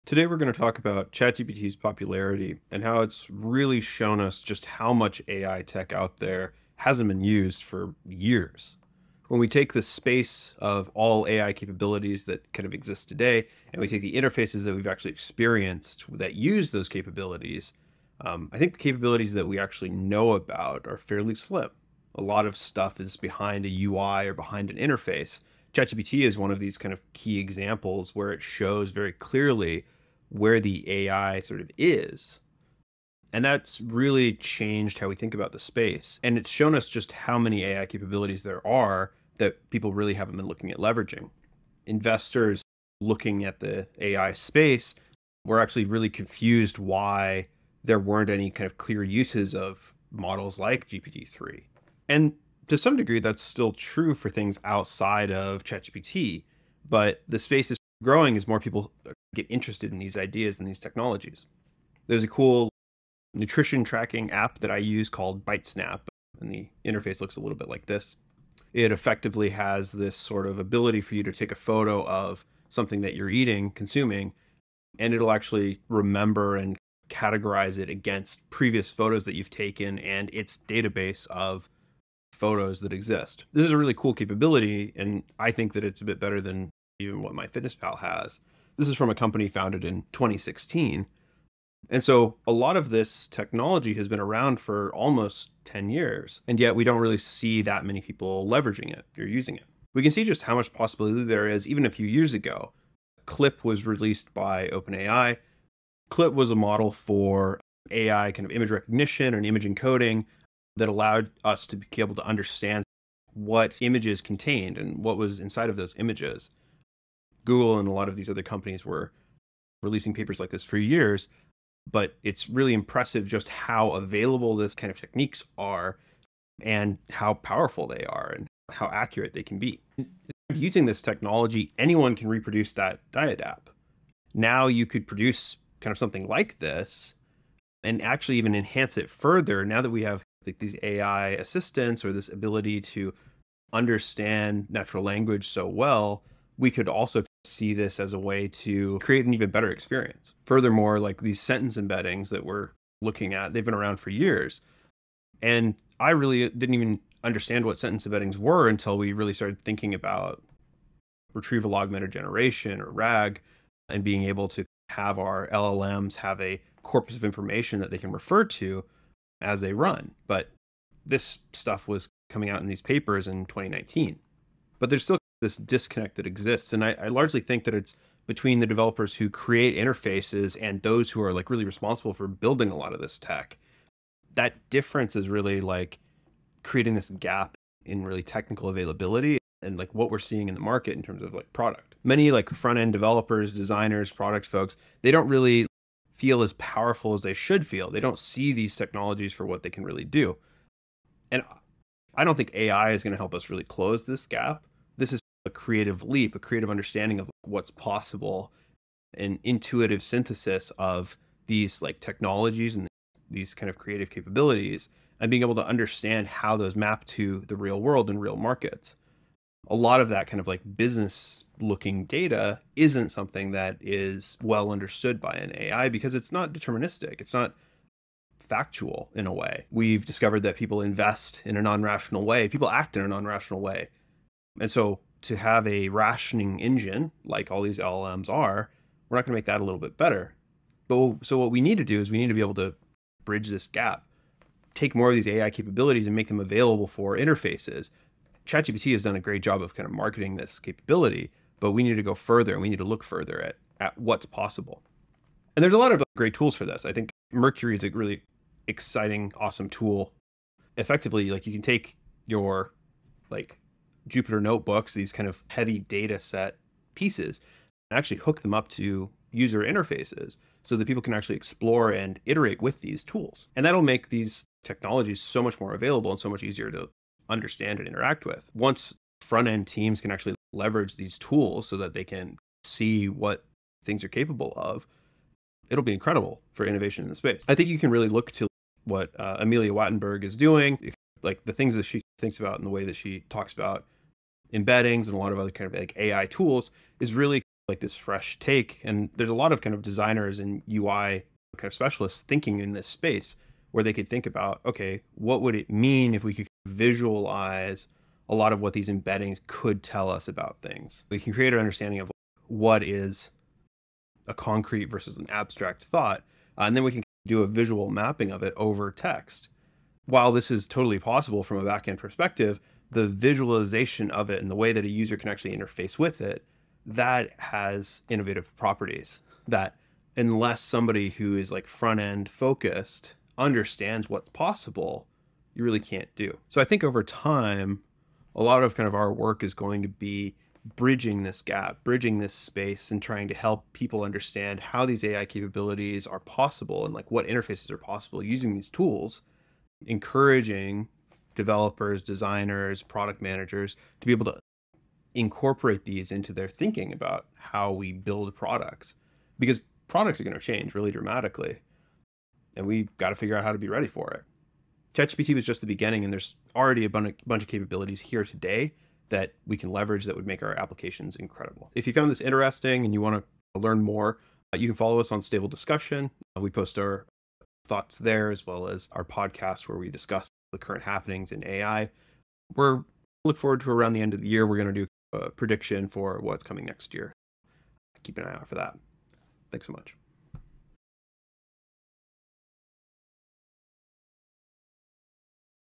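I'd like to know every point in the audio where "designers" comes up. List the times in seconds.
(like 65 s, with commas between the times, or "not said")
193 s, 299 s, 352 s.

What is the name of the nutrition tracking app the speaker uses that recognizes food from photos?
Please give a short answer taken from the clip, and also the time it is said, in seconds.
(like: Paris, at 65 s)
BiteSnap, at 65 s.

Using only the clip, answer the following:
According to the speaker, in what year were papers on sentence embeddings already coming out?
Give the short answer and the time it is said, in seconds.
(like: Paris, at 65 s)
2019, at 173 s.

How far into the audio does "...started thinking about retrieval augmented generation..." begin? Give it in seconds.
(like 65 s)
159 s.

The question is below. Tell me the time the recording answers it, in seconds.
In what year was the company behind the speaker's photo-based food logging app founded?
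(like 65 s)
90 s.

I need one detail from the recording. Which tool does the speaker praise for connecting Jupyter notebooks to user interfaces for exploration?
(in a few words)
Mercury.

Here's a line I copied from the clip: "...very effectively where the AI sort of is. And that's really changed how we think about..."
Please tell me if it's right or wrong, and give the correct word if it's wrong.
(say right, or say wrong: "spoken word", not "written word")
wrong: "clearly", not "effectively".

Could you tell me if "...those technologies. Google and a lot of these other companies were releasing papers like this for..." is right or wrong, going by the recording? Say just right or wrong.
wrong.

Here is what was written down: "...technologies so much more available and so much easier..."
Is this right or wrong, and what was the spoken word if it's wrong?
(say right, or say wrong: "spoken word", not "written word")
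right.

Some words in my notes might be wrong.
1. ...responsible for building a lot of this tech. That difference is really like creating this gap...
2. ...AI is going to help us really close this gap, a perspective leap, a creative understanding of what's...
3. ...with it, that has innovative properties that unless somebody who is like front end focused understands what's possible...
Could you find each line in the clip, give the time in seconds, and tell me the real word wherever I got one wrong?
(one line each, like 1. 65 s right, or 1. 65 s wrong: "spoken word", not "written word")
1. 181 s right
2. 202 s wrong: "creative", not "perspective"
3. 325 s right.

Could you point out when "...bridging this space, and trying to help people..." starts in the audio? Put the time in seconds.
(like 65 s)
341 s.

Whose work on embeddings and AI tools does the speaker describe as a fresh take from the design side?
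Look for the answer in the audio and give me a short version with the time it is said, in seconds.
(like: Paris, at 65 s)
Amelia Wattenberger, at 289 s.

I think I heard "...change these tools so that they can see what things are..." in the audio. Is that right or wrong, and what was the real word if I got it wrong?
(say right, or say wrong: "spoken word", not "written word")
wrong: "leverage", not "change".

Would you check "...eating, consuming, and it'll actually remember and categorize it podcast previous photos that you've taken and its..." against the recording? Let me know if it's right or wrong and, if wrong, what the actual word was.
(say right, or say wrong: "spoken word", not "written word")
wrong: "against", not "podcast".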